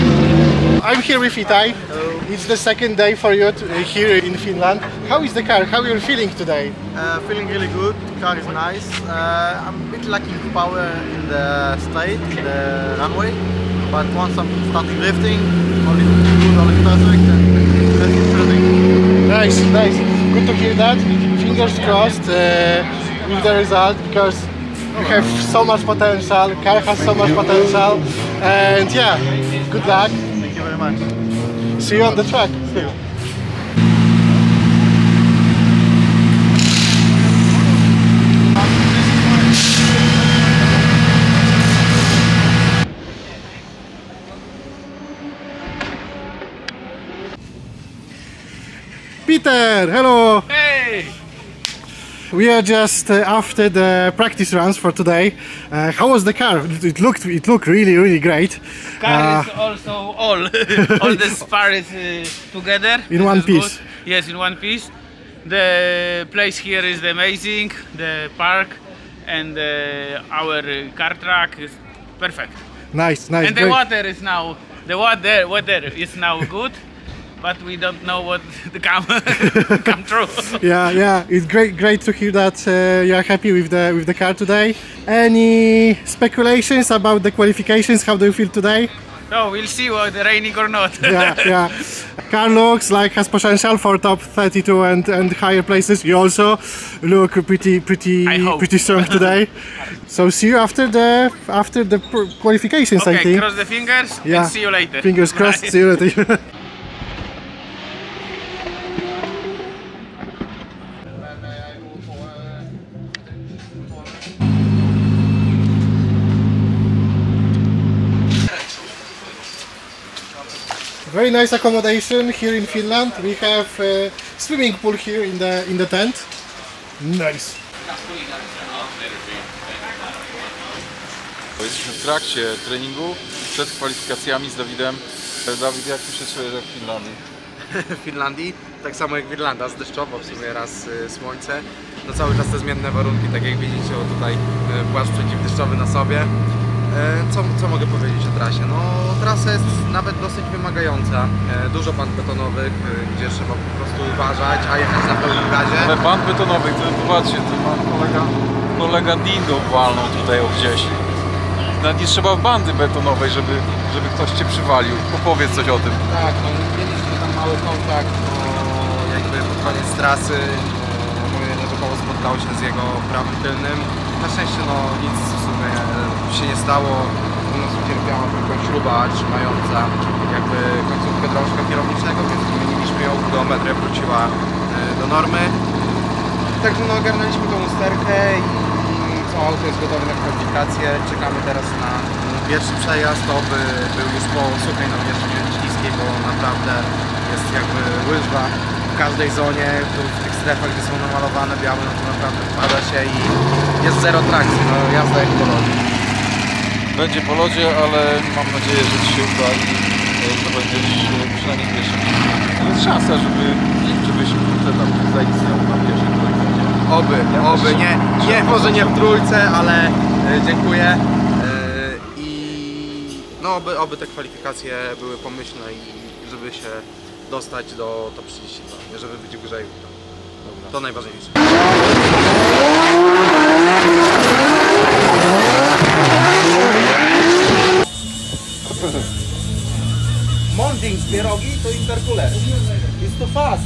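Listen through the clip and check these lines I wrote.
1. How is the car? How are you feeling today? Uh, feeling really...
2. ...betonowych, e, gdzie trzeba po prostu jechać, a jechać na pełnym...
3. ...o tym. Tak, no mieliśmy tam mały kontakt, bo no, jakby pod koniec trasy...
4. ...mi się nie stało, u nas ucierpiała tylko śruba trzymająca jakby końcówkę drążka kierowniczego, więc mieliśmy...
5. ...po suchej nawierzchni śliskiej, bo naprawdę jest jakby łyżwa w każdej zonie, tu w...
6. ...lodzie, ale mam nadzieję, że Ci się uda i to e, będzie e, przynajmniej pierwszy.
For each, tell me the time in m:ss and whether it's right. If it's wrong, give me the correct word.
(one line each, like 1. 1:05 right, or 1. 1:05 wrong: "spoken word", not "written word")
1. 0:05 right
2. 2:32 wrong: "uważać", not "jechać"
3. 2:45 right
4. 2:56 wrong: "zmieniliśmy", not "mieliśmy"
5. 3:14 right
6. 3:27 right.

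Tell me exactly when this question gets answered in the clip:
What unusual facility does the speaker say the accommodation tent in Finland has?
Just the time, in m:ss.
2:04.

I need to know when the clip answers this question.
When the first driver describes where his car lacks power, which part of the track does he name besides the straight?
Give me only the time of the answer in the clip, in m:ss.
0:12.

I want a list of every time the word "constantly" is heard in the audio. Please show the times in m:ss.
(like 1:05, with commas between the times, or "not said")
not said.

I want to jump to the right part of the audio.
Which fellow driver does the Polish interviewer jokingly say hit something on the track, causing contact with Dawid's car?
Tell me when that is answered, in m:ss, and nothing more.
2:39.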